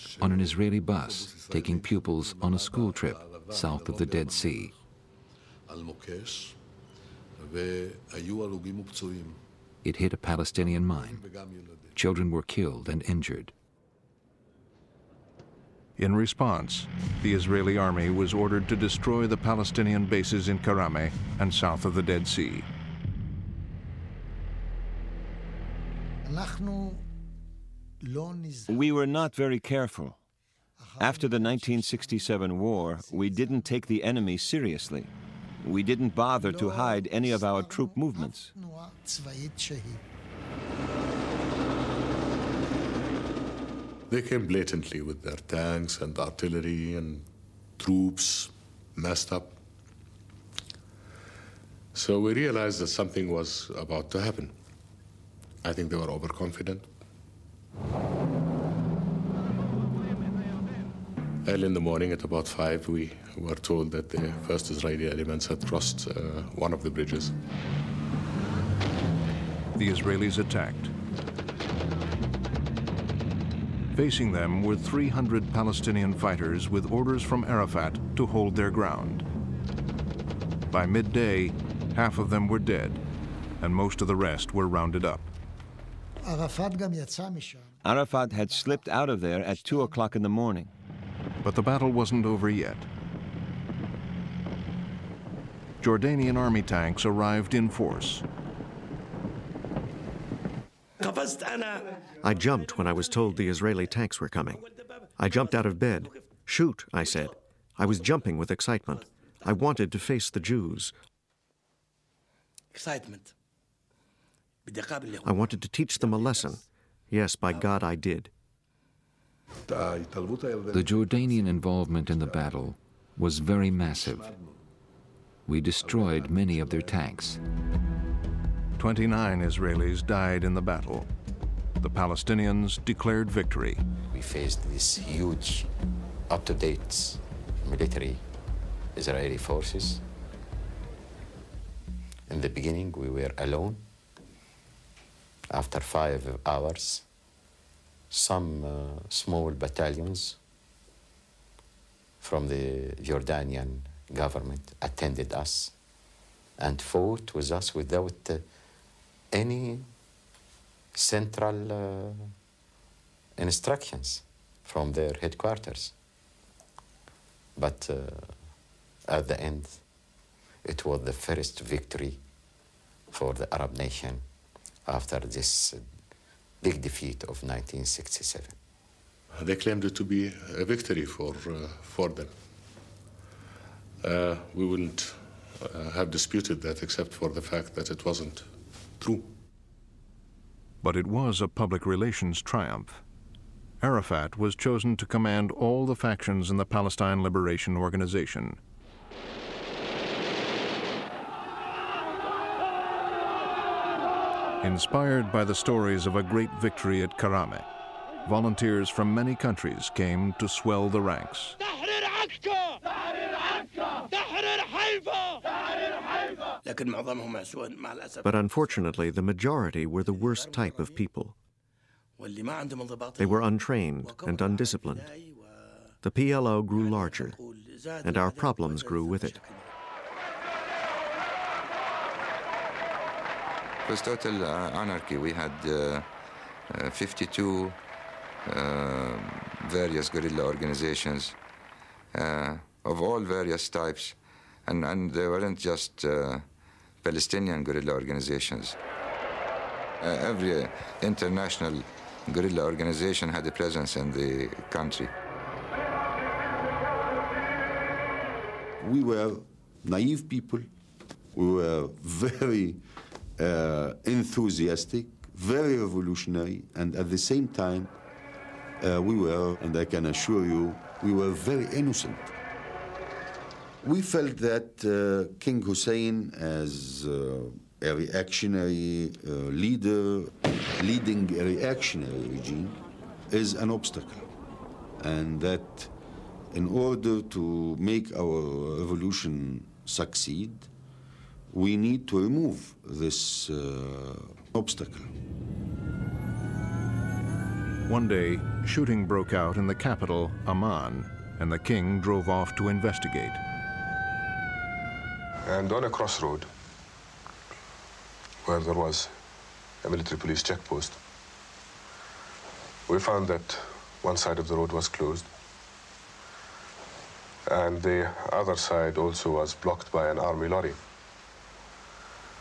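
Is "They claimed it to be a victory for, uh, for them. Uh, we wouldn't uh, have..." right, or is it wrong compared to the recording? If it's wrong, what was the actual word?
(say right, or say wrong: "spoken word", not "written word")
right.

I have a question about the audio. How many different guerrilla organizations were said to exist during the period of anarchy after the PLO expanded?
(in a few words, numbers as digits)
52.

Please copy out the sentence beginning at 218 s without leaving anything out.
But unfortunately, the majority were the worst type of people.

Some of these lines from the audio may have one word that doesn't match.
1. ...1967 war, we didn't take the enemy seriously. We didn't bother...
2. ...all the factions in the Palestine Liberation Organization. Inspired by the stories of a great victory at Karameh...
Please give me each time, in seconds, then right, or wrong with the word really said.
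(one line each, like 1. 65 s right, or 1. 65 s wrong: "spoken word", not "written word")
1. 31 s right
2. 195 s right.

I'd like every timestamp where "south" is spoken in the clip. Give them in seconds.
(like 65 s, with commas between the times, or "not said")
3 s, 21 s.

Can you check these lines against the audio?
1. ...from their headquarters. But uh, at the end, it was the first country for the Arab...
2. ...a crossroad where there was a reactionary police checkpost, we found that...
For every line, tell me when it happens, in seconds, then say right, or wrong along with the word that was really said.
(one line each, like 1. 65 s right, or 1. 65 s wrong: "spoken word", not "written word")
1. 164 s wrong: "victory", not "country"
2. 305 s wrong: "military", not "reactionary".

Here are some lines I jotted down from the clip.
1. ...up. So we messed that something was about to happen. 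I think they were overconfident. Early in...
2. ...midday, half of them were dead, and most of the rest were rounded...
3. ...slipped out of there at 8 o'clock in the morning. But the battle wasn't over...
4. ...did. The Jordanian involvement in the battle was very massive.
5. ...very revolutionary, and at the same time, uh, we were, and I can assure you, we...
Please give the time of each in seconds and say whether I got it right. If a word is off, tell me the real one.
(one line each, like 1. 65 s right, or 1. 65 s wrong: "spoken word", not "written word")
1. 49 s wrong: "realized", not "messed"
2. 80 s right
3. 88 s wrong: "2", not "8"
4. 117 s right
5. 265 s right.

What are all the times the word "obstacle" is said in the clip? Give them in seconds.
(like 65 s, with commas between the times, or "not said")
283 s, 294 s.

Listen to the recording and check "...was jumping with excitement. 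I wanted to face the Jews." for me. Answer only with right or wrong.
right.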